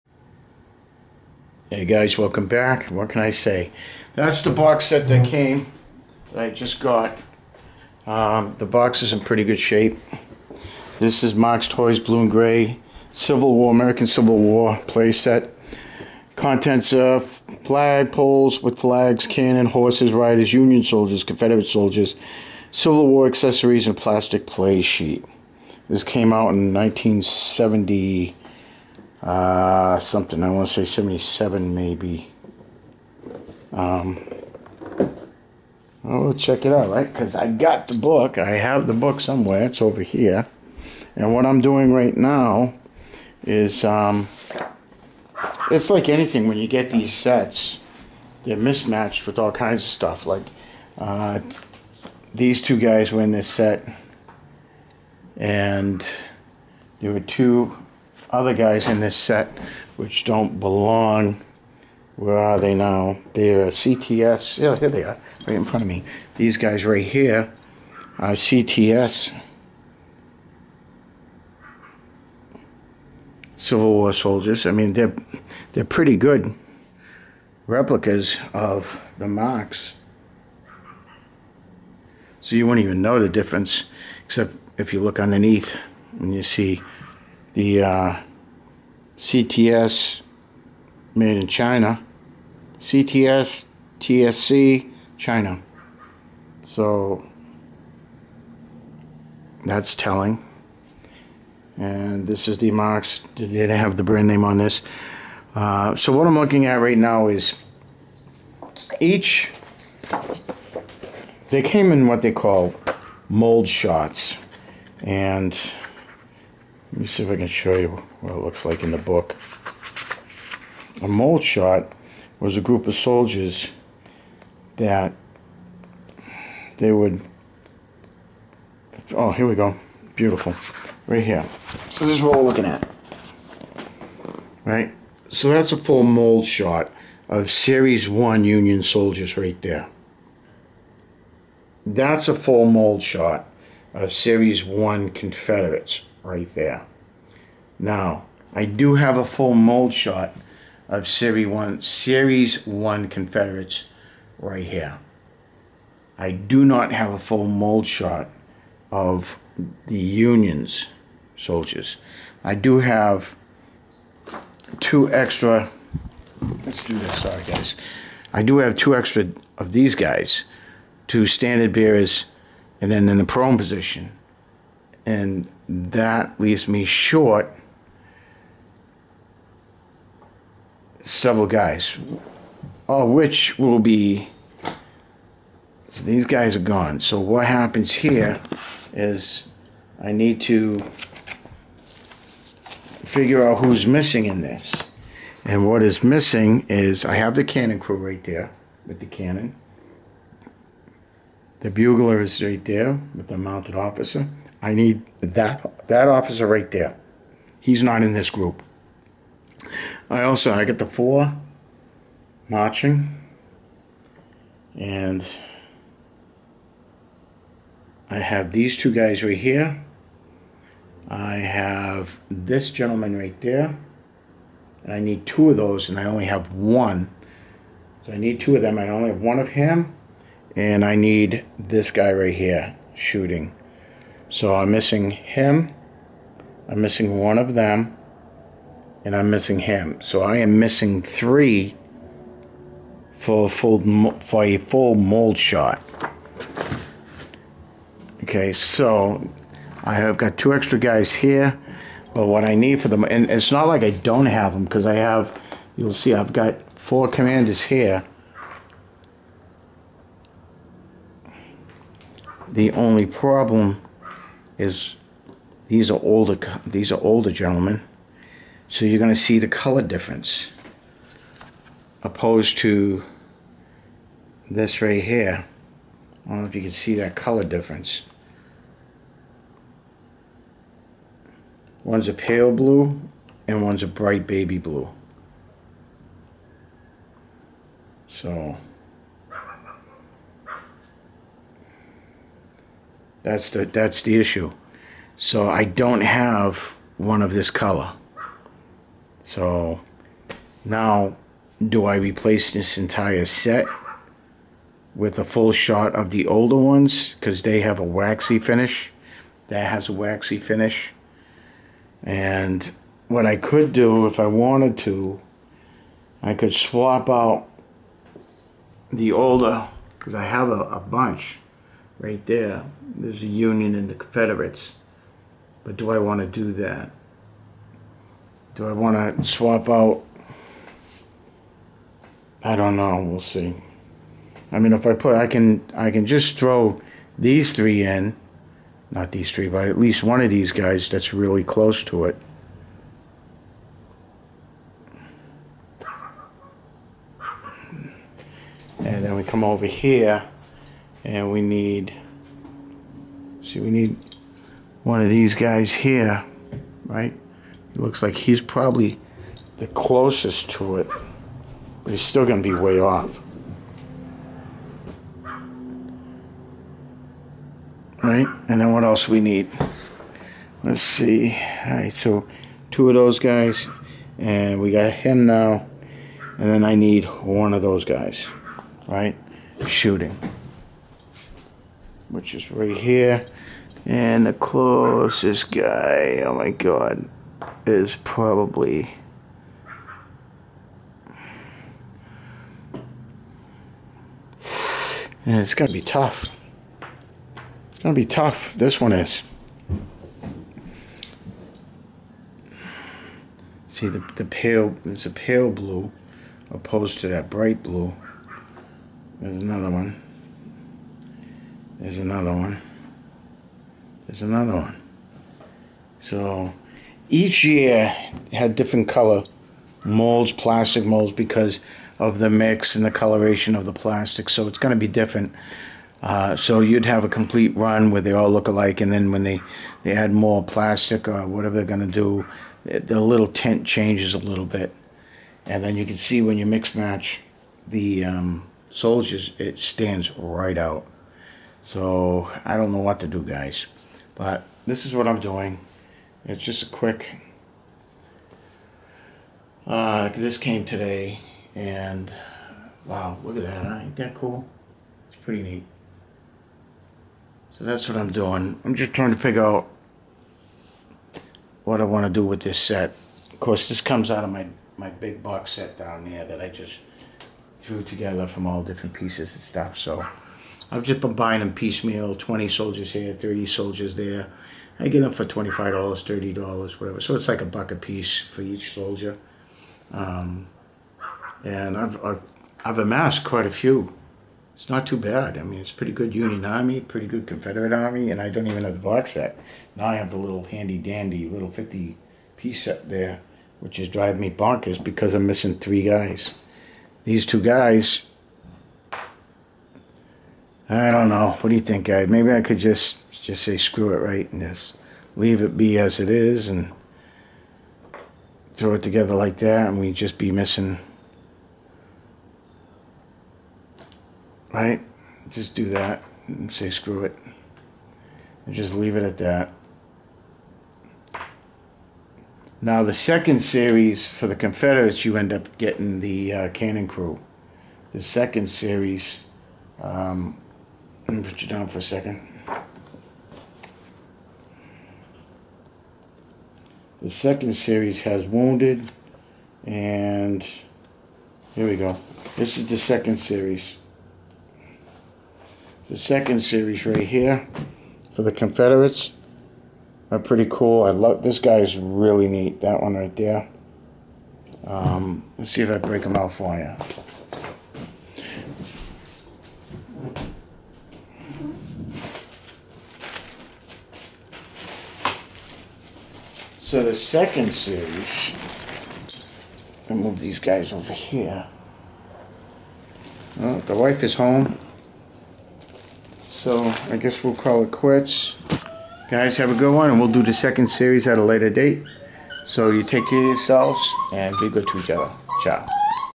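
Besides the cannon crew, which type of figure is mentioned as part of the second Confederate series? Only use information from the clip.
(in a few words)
Wounded.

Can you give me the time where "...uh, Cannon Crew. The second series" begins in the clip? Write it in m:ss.
8:46.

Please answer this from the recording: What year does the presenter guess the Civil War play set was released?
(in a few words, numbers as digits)
1977.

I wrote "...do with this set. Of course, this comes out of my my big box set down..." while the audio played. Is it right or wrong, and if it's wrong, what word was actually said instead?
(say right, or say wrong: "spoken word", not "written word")
right.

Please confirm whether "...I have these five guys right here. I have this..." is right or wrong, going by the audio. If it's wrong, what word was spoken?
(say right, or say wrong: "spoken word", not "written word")
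wrong: "two", not "five".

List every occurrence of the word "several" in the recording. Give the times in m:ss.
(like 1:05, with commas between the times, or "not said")
3:01.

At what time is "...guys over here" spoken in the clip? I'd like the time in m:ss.
9:30.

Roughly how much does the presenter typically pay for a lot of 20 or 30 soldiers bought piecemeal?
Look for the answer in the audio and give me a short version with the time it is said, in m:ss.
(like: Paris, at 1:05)
$25 to $30, at 7:55.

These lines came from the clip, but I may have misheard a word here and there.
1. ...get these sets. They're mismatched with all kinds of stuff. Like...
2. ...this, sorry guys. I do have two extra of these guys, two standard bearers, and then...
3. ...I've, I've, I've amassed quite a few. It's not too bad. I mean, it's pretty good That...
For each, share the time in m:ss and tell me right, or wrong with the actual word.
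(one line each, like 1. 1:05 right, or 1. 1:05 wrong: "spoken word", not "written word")
1. 0:46 right
2. 2:46 right
3. 8:01 wrong: "Union", not "That".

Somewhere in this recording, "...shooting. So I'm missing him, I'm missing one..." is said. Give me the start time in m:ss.
3:52.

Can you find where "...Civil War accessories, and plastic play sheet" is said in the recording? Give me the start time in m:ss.
0:22.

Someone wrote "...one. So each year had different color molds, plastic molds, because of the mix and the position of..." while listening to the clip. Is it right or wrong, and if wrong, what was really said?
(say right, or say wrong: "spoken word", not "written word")
wrong: "coloration", not "position".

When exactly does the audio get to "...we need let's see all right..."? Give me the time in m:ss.
6:09.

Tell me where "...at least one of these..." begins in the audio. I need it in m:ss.
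5:39.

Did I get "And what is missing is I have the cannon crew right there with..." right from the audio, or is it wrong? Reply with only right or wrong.
right.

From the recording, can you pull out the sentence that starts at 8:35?
Just do that and say screw it, and just leave it at that.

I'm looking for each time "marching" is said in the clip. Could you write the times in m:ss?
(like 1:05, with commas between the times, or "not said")
3:32.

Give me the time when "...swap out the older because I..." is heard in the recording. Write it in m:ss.
5:16.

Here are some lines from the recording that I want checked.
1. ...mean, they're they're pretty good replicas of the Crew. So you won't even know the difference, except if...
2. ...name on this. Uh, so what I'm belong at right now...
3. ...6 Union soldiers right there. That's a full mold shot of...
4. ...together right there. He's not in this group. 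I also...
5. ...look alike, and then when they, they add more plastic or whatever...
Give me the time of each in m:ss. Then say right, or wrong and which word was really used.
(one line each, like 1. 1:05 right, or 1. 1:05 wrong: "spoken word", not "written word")
1. 1:14 wrong: "Marx", not "Crew"
2. 1:44 wrong: "looking", not "belong"
3. 2:18 wrong: "1", not "6"
4. 3:26 wrong: "officer", not "together"
5. 7:08 right.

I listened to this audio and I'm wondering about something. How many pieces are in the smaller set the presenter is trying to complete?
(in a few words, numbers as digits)
50.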